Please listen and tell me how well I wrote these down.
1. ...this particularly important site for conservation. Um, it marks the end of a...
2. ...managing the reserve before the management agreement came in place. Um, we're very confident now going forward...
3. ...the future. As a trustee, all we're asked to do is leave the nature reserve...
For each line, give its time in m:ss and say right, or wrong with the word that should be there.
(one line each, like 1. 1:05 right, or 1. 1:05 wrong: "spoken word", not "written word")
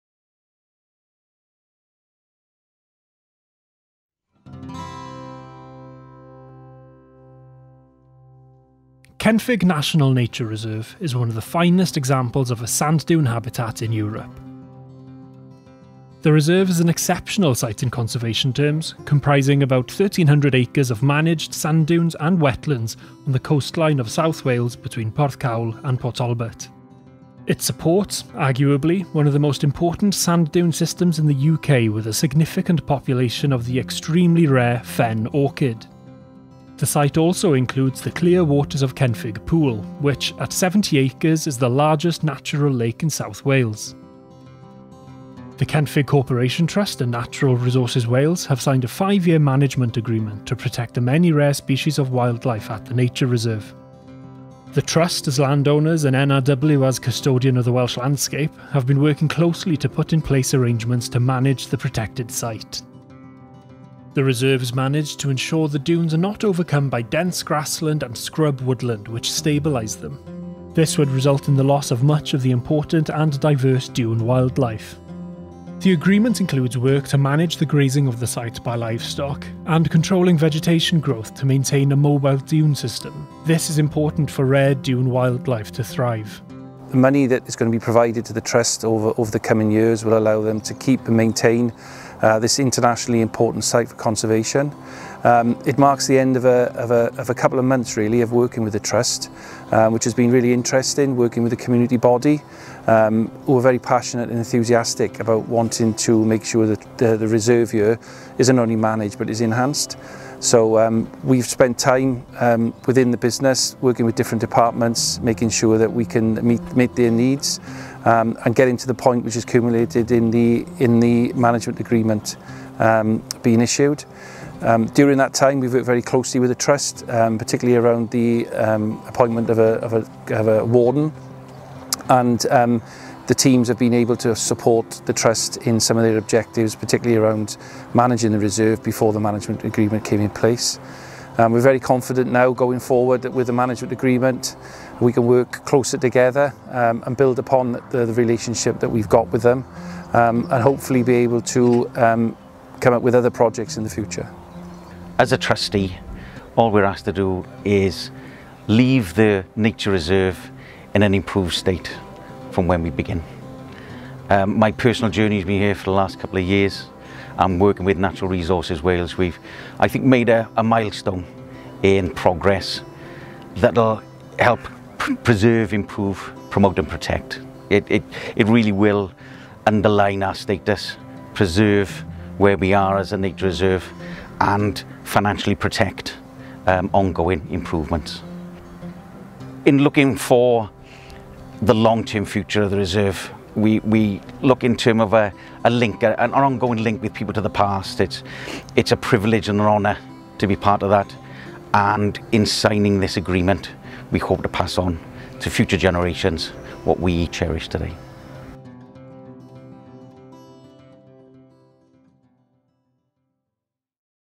1. 1:32 wrong: "internationally", not "particularly"
2. 2:17 right
3. 2:33 right.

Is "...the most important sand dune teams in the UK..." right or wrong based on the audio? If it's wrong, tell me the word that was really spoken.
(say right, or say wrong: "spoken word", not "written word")
wrong: "systems", not "teams".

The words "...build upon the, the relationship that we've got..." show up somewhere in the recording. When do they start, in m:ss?
2:27.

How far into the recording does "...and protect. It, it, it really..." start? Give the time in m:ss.
2:56.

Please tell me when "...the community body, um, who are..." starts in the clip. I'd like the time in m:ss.
1:41.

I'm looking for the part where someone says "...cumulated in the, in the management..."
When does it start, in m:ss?
1:59.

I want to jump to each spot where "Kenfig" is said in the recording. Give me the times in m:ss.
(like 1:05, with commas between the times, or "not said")
0:09, 0:38, 0:45.